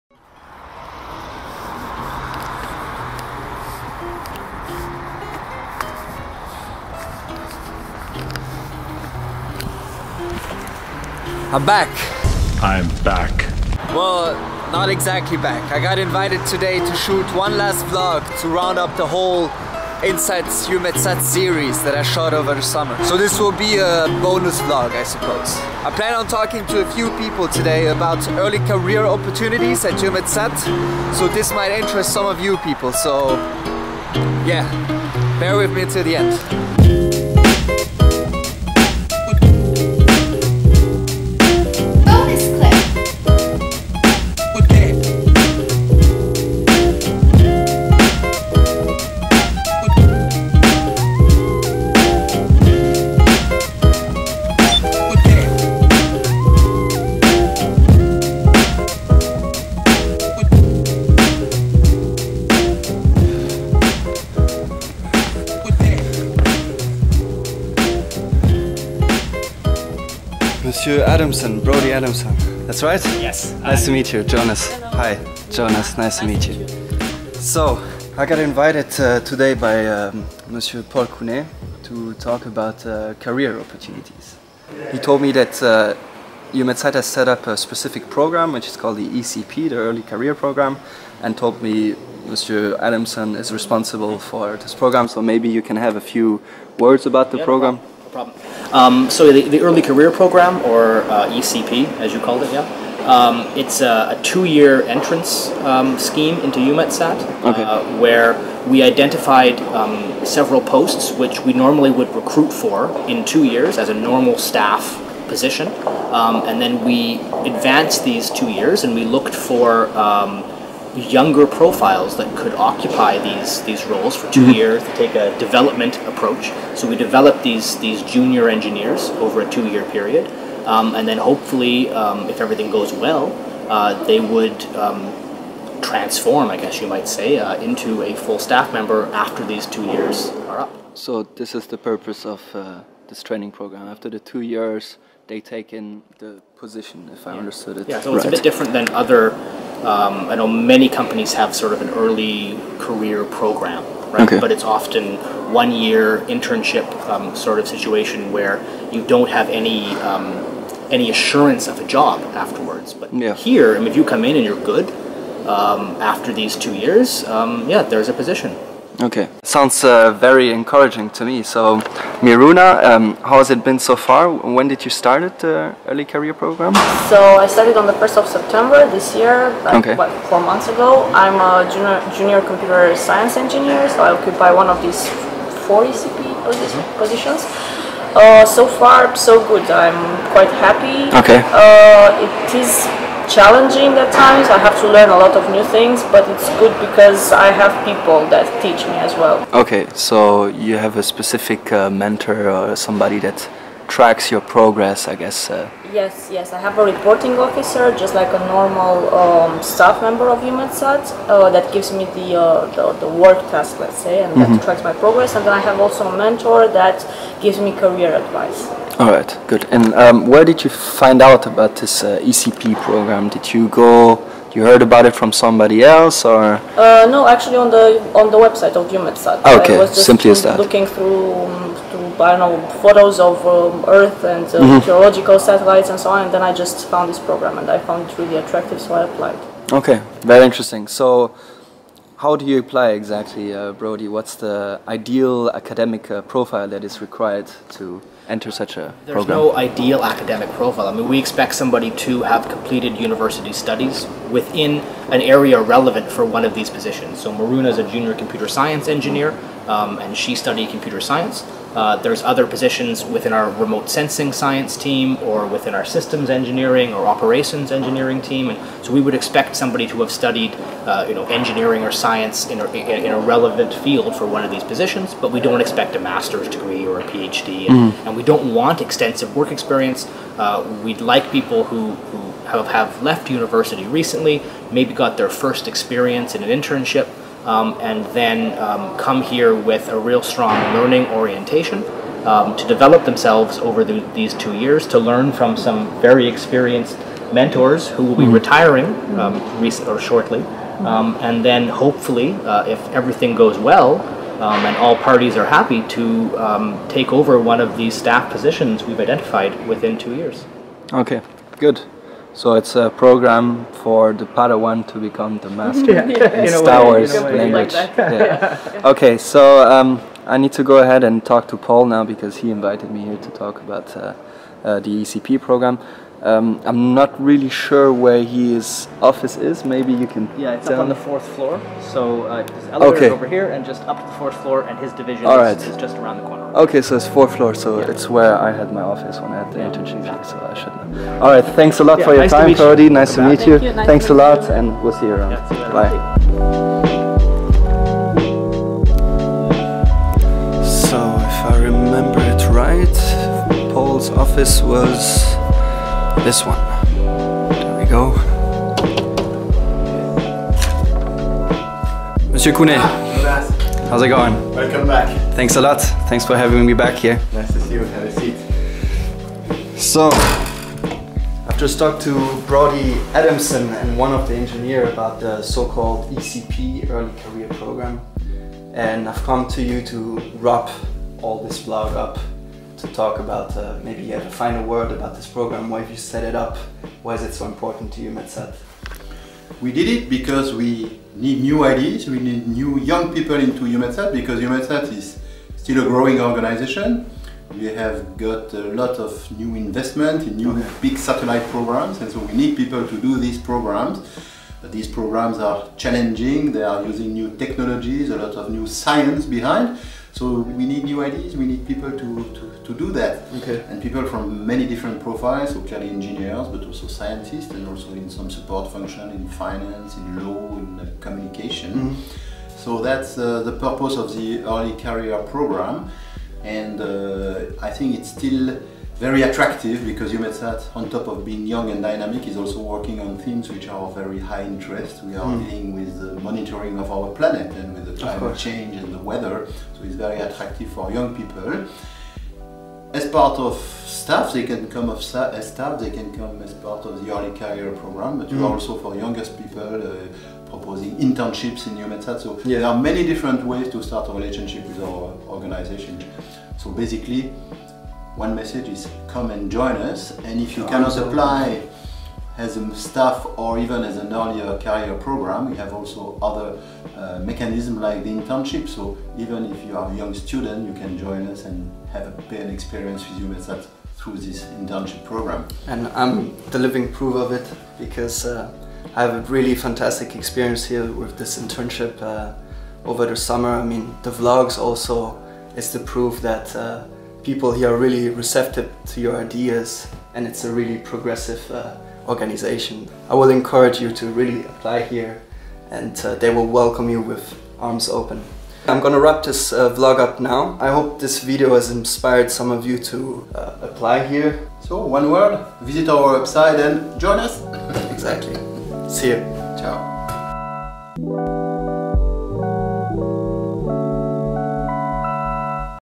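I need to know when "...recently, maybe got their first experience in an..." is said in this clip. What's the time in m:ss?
4:43.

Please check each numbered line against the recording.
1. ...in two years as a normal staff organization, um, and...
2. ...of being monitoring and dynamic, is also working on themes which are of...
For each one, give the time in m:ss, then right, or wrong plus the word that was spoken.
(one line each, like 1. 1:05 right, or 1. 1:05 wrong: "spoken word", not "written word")
1. 1:53 wrong: "position", not "organization"
2. 7:11 wrong: "young", not "monitoring".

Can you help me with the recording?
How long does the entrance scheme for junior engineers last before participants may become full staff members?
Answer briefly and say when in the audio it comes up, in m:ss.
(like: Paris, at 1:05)
2 years, at 1:44.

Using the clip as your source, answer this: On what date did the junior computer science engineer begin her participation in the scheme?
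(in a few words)
1 September.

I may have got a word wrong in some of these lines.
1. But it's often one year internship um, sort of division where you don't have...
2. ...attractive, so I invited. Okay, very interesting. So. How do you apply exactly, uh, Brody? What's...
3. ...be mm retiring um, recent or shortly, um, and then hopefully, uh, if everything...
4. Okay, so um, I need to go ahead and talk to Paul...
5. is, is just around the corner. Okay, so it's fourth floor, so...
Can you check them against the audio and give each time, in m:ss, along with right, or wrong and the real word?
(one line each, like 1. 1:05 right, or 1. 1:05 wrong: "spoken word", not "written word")
1. 2:34 wrong: "situation", not "division"
2. 3:58 wrong: "applied", not "invited"
3. 4:58 right
4. 5:18 right
5. 5:35 right.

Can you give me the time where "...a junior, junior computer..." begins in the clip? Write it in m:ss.
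3:01.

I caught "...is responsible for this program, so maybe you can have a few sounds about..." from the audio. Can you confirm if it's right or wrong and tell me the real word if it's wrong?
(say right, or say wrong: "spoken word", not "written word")
wrong: "words", not "sounds".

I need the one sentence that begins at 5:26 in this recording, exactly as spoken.
Um, I'm not really sure where his office is.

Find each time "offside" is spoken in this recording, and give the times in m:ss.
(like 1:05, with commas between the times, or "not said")
not said.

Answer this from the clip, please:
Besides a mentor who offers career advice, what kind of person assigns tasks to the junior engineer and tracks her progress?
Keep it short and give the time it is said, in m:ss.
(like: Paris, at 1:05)
reporting officer, at 3:26.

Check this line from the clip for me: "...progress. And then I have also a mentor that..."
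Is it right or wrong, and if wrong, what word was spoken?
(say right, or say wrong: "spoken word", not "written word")
right.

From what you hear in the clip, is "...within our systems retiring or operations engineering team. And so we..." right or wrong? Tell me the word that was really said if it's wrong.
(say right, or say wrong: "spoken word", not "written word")
wrong: "engineering", not "retiring".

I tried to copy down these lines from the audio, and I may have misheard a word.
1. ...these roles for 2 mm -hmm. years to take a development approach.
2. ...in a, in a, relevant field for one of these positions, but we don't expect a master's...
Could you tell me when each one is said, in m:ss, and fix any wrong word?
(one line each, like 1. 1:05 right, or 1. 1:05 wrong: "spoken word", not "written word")
1. 2:03 right
2. 4:32 right.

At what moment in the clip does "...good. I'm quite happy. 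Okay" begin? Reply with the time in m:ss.
3:09.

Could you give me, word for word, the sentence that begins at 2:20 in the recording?
So this is the purpose of uh, this training program.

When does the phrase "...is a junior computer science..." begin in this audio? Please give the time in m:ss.
4:17.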